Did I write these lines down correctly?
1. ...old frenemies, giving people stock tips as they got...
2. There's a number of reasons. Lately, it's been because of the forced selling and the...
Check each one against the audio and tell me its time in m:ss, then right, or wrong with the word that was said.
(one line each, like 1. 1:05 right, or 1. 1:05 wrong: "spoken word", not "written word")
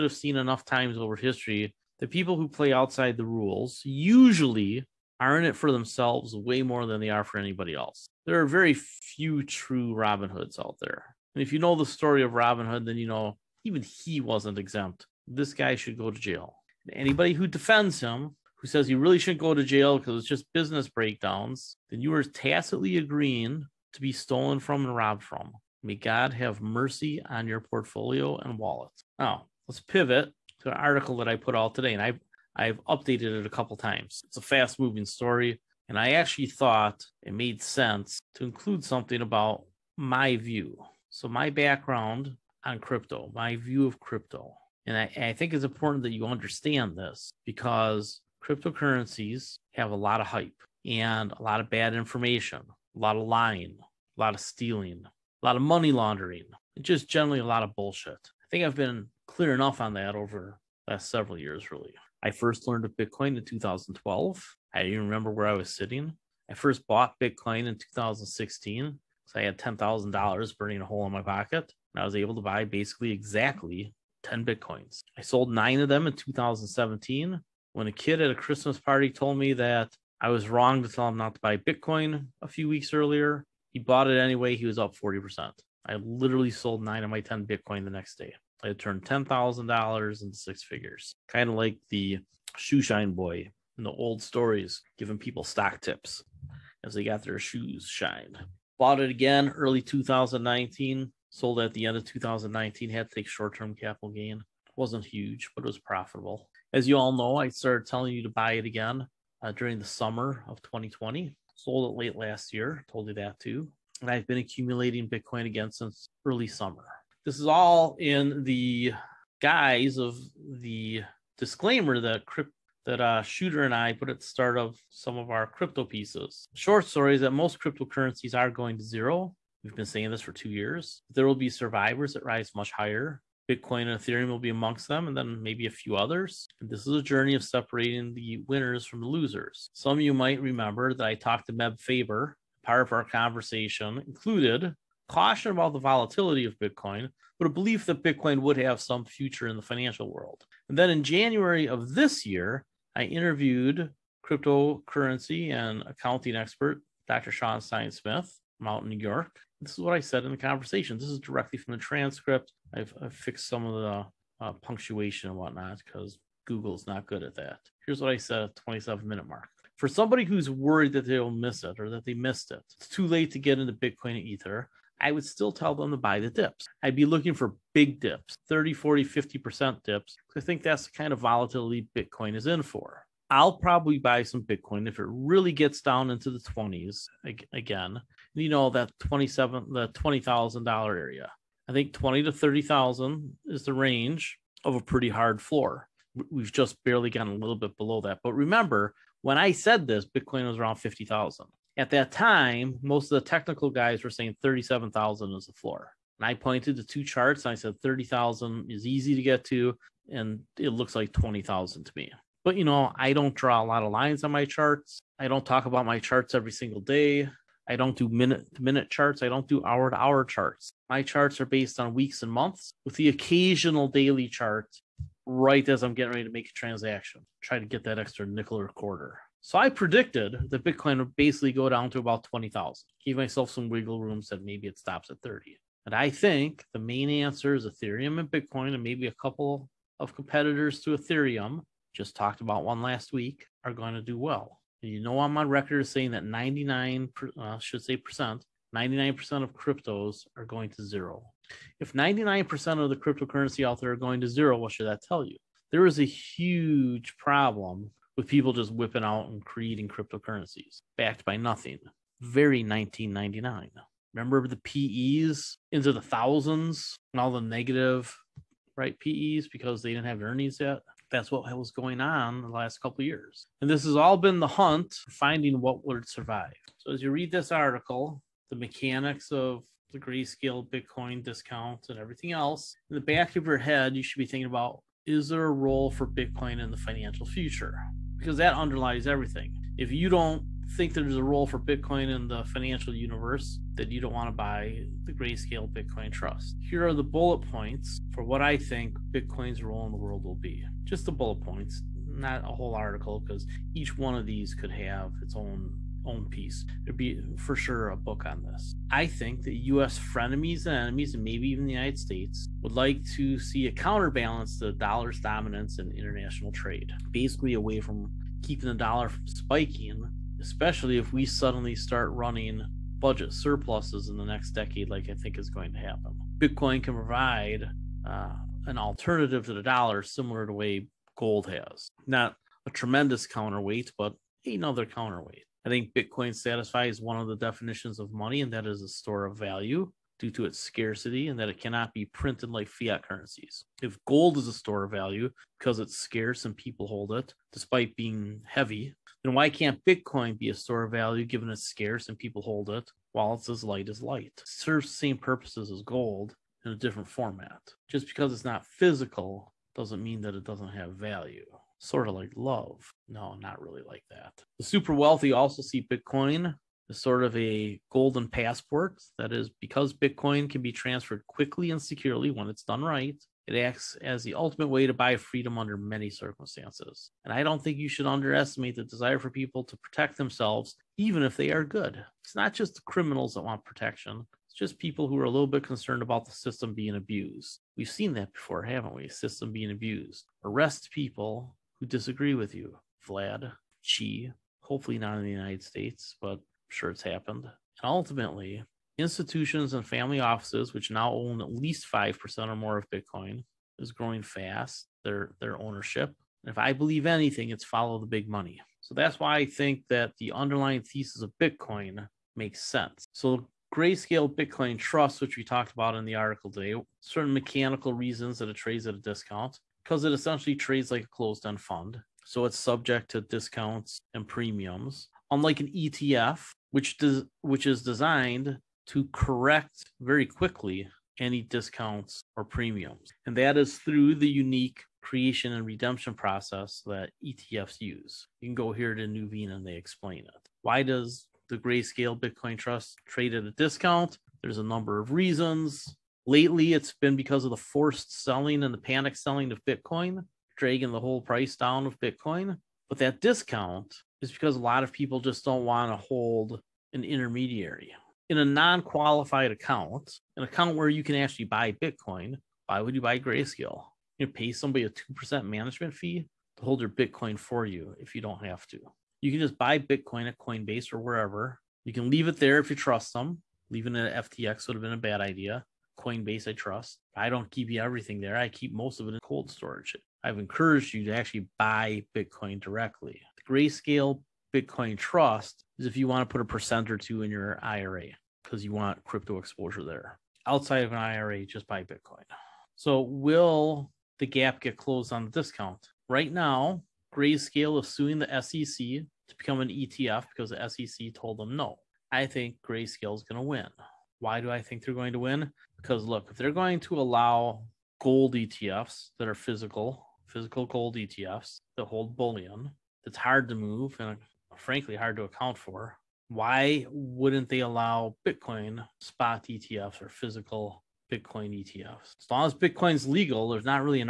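1. 1:33 wrong: "stories", not "frenemies"
2. 7:24 right.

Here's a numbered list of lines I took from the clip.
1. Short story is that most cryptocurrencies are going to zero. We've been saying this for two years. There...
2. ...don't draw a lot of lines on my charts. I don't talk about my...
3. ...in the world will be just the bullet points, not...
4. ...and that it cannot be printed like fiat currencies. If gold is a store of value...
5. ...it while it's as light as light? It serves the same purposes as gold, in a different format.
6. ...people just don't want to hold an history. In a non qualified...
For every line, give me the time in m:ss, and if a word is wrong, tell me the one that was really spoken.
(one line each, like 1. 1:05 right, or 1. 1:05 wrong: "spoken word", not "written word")
1. 2:06 right
2. 3:33 right
3. 4:59 right
4. 5:41 right
5. 5:52 right
6. 7:34 wrong: "intermediary", not "history".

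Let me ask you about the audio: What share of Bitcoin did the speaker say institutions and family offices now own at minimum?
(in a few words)
5%.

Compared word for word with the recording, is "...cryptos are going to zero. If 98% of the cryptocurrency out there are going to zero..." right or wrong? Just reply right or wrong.
wrong.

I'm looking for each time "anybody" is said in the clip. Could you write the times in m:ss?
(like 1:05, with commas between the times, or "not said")
0:07, 0:16.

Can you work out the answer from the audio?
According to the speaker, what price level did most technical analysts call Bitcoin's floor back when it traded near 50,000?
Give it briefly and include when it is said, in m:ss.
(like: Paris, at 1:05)
37,000, at 3:24.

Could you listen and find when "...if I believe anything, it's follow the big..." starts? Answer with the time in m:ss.
6:46.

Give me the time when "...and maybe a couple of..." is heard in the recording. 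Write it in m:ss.
3:58.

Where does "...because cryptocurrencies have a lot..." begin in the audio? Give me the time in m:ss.
0:47.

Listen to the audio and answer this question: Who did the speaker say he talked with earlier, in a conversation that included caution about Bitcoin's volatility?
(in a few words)
Meb Faber.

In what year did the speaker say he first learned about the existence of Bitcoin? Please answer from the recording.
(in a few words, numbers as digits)
2012.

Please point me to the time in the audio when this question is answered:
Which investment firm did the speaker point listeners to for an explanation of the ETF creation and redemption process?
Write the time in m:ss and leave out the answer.
7:19.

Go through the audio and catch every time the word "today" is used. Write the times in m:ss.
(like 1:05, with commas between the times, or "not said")
0:31, 6:56.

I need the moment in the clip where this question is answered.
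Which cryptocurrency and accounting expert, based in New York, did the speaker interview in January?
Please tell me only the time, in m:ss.
2:37.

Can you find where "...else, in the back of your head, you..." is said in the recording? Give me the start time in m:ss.
4:42.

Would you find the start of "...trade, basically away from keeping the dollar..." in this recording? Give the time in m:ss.
5:16.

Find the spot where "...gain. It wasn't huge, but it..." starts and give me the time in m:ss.
1:44.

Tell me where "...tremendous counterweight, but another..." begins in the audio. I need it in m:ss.
5:32.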